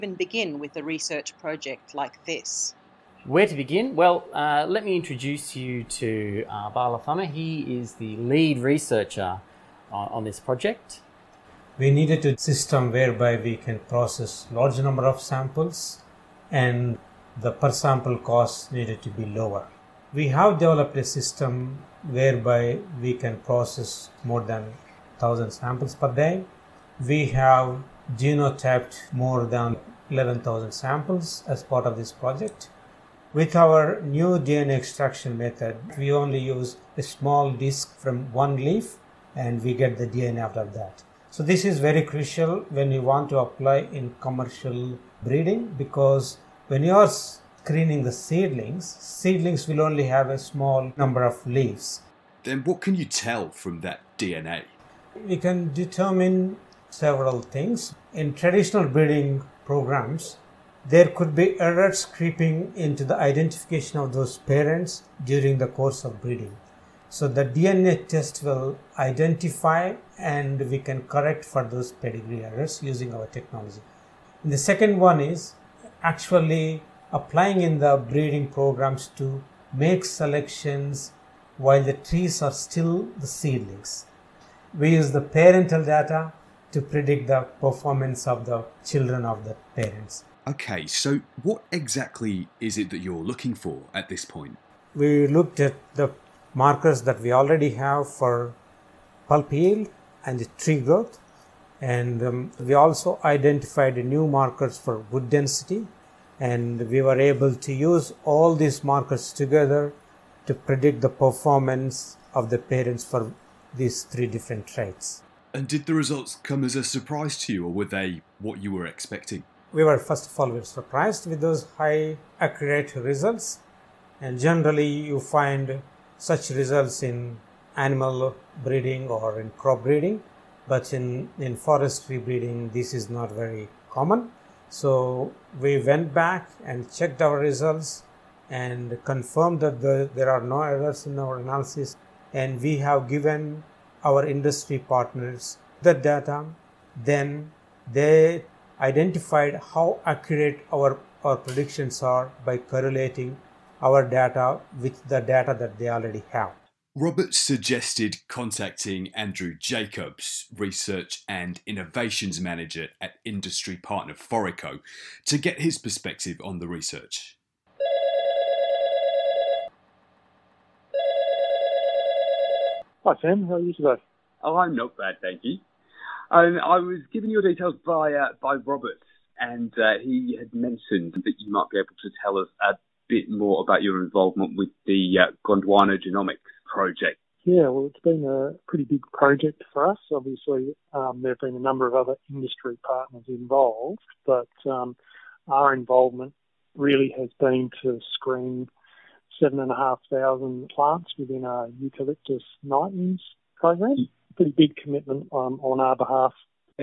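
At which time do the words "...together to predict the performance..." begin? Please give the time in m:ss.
1:49.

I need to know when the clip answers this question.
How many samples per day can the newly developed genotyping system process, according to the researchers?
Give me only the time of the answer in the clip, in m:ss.
0:24.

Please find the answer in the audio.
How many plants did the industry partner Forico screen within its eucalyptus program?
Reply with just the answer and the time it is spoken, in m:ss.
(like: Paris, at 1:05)
7,500, at 3:19.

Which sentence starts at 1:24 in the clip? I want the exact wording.
We use the parental data to predict the performance of the children of the parents.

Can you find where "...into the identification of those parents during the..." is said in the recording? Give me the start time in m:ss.
1:02.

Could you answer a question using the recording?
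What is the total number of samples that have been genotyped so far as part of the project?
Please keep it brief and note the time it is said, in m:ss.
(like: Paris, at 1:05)
more than 11,000, at 0:29.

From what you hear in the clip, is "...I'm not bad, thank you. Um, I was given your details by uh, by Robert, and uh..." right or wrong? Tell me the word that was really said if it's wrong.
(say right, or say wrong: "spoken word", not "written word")
right.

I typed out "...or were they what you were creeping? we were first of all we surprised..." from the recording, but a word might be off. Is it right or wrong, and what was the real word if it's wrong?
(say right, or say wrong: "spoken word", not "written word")
wrong: "expecting", not "creeping".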